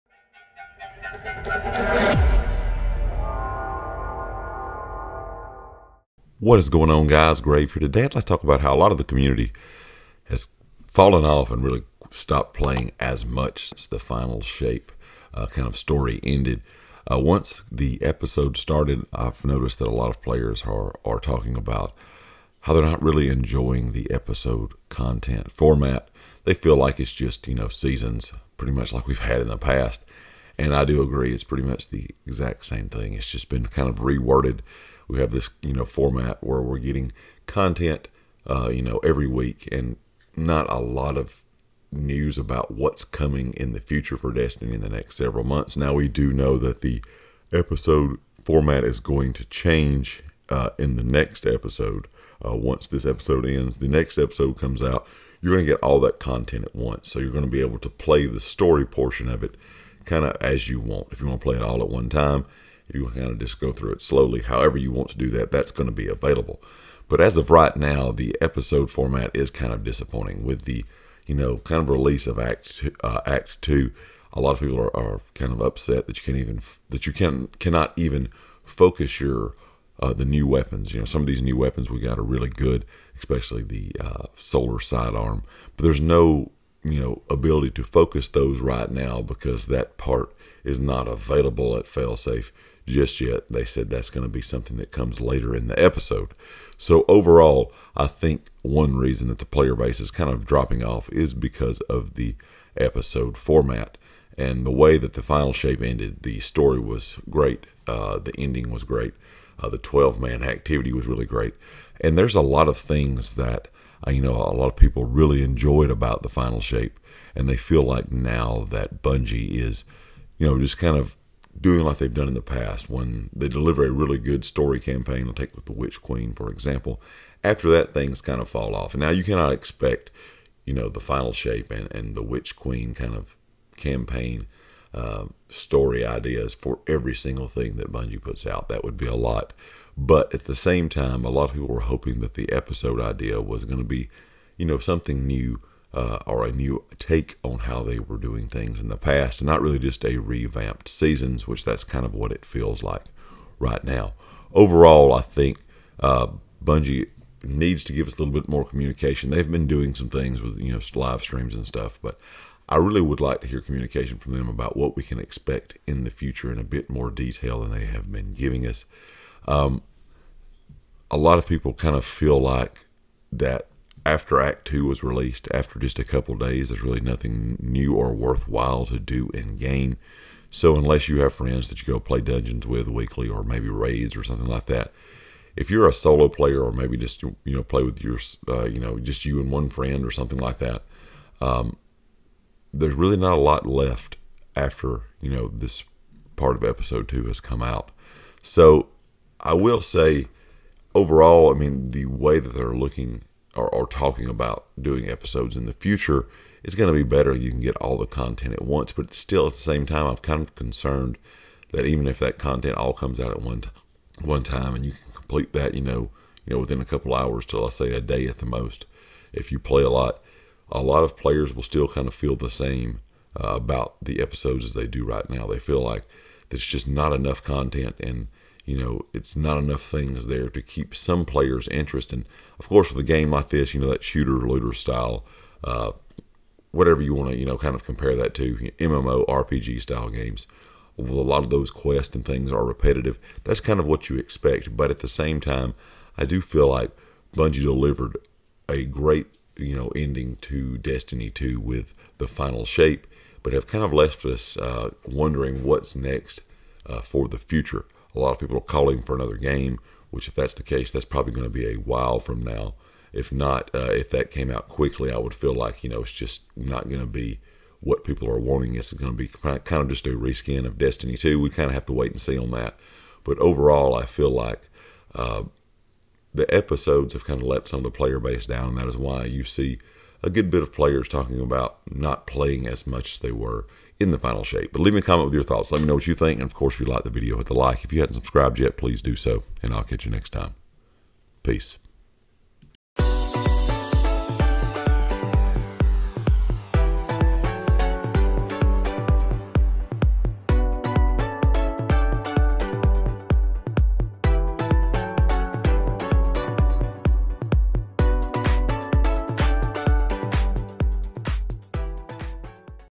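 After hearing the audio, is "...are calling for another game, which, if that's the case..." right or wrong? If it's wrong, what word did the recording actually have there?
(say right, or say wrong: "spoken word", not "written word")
right.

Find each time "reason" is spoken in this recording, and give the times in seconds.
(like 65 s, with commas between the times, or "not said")
98 s.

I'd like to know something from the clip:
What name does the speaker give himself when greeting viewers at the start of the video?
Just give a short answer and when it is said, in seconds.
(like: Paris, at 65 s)
Grave, at 7 s.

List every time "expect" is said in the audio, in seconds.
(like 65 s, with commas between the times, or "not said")
129 s, 165 s, 244 s.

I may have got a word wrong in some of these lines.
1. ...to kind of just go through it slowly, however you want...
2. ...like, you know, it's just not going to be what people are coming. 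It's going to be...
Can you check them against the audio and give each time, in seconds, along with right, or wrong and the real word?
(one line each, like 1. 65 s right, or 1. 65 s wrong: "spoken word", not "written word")
1. 63 s right
2. 265 s wrong: "wanting", not "coming".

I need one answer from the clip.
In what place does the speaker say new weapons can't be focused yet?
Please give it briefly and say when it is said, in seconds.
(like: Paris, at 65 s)
Failsafe, at 91 s.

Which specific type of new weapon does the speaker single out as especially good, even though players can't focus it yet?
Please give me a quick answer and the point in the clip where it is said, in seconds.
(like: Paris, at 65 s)
Solar sidearm, at 84 s.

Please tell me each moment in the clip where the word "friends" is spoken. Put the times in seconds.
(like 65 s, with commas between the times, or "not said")
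181 s, 189 s.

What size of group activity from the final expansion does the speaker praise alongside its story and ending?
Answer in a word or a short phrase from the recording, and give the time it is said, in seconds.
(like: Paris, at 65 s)
12 man, at 109 s.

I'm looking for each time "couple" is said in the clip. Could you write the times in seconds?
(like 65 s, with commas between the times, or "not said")
176 s, 216 s.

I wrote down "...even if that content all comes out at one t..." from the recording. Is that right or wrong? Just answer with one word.
right.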